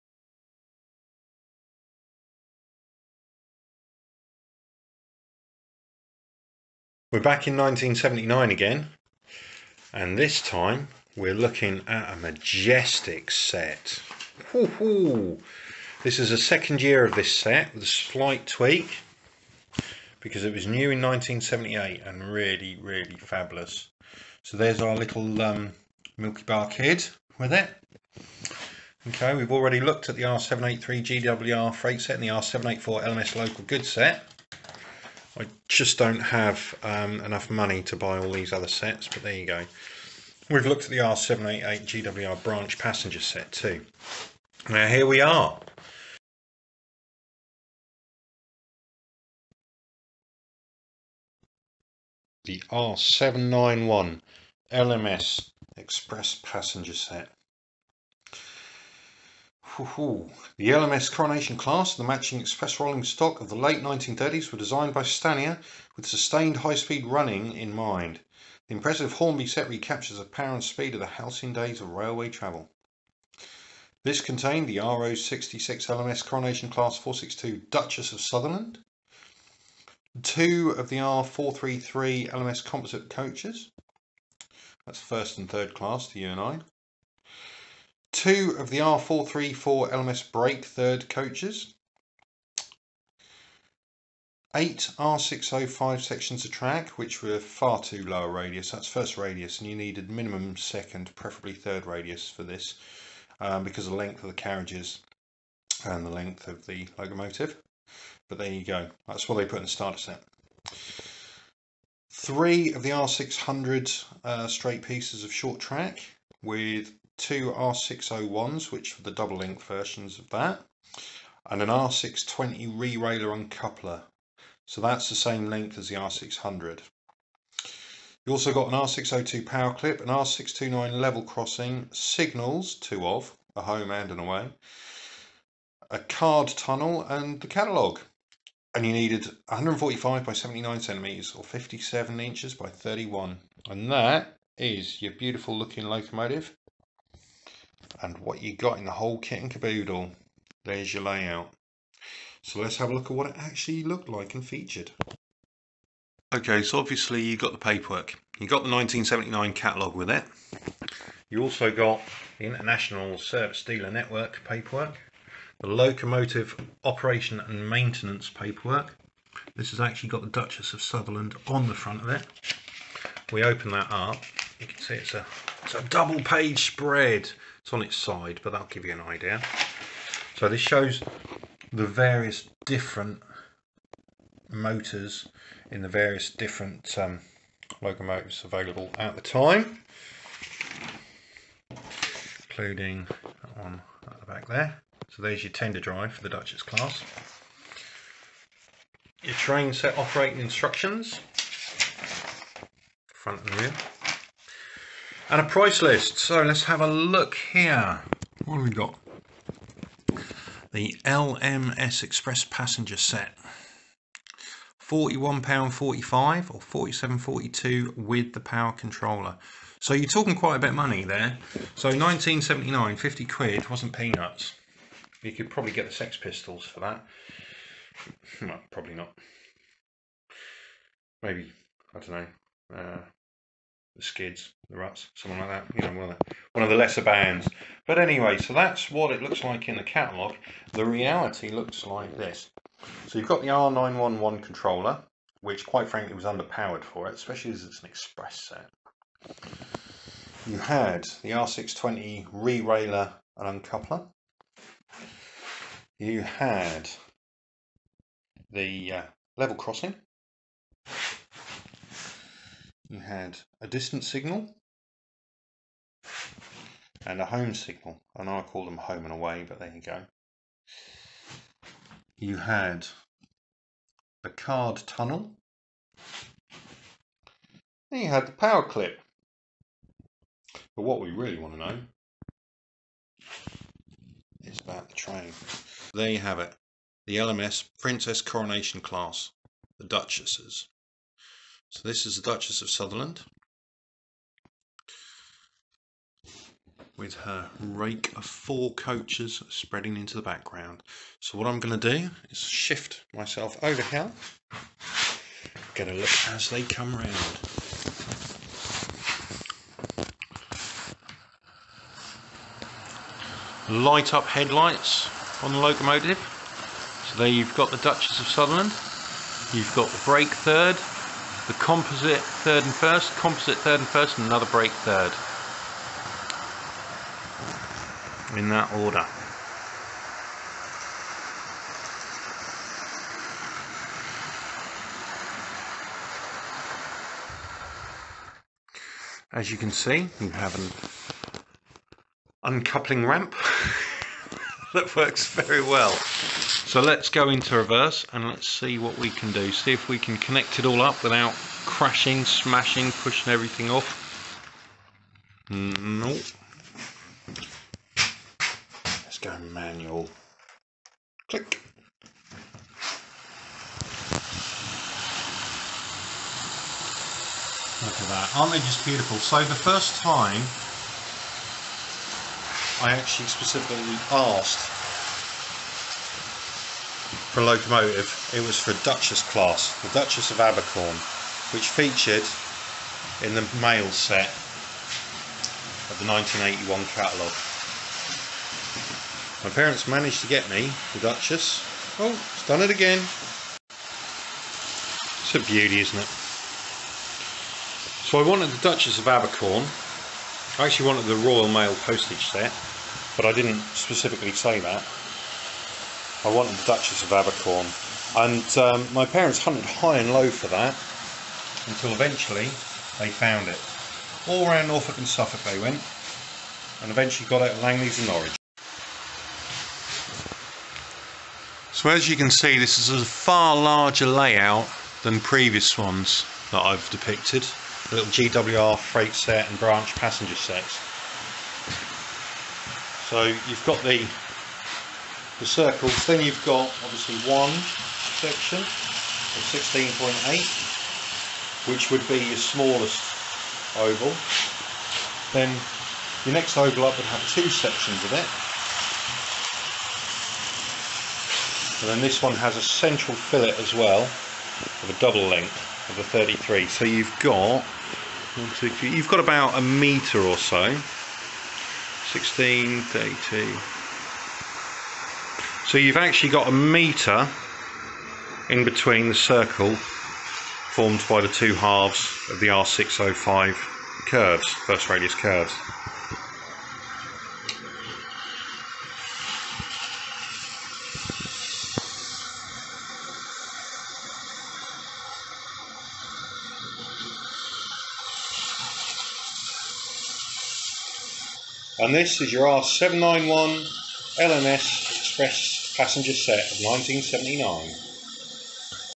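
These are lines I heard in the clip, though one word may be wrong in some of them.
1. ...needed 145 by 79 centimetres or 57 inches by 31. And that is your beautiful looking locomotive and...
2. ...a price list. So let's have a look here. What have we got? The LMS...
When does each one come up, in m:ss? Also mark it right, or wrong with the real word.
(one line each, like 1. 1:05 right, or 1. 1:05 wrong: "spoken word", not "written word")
1. 2:18 right
2. 3:25 right.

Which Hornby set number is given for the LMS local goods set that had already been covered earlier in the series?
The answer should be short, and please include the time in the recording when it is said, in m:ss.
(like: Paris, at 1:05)
R784, at 0:32.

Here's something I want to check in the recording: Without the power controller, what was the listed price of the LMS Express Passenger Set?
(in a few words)
£41.45.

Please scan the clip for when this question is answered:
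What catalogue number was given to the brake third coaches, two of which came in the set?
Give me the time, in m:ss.
1:28.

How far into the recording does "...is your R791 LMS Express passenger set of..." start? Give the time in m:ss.
8:12.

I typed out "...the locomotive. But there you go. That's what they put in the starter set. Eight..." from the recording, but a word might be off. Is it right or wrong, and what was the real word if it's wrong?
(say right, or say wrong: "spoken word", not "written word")
wrong: "Three", not "Eight".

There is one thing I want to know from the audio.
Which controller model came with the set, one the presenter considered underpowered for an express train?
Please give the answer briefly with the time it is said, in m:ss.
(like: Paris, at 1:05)
R911, at 4:03.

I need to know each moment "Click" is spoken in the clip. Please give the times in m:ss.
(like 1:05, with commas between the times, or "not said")
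6:01.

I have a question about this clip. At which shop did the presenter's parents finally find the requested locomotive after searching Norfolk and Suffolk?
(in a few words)
Langley's.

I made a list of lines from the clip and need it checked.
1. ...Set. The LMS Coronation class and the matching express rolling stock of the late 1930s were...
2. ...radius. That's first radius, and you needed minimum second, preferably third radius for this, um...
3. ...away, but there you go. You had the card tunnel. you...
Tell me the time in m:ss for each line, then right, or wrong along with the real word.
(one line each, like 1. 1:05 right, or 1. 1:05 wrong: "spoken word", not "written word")
1. 0:56 right
2. 1:38 right
3. 4:29 right.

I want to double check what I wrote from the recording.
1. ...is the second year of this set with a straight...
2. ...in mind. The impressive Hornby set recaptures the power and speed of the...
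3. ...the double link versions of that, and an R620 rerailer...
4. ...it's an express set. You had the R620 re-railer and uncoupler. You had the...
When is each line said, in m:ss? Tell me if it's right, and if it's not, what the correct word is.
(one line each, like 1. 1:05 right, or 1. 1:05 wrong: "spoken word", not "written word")
1. 0:16 wrong: "slight", not "straight"
2. 1:07 right
3. 1:59 right
4. 4:07 right.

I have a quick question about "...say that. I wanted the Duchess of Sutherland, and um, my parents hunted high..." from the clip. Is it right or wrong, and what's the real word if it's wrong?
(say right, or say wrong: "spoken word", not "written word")
wrong: "Abercorn", not "Sutherland".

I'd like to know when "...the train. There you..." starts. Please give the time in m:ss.
4:44.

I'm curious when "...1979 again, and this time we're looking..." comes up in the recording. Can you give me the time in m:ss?
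0:07.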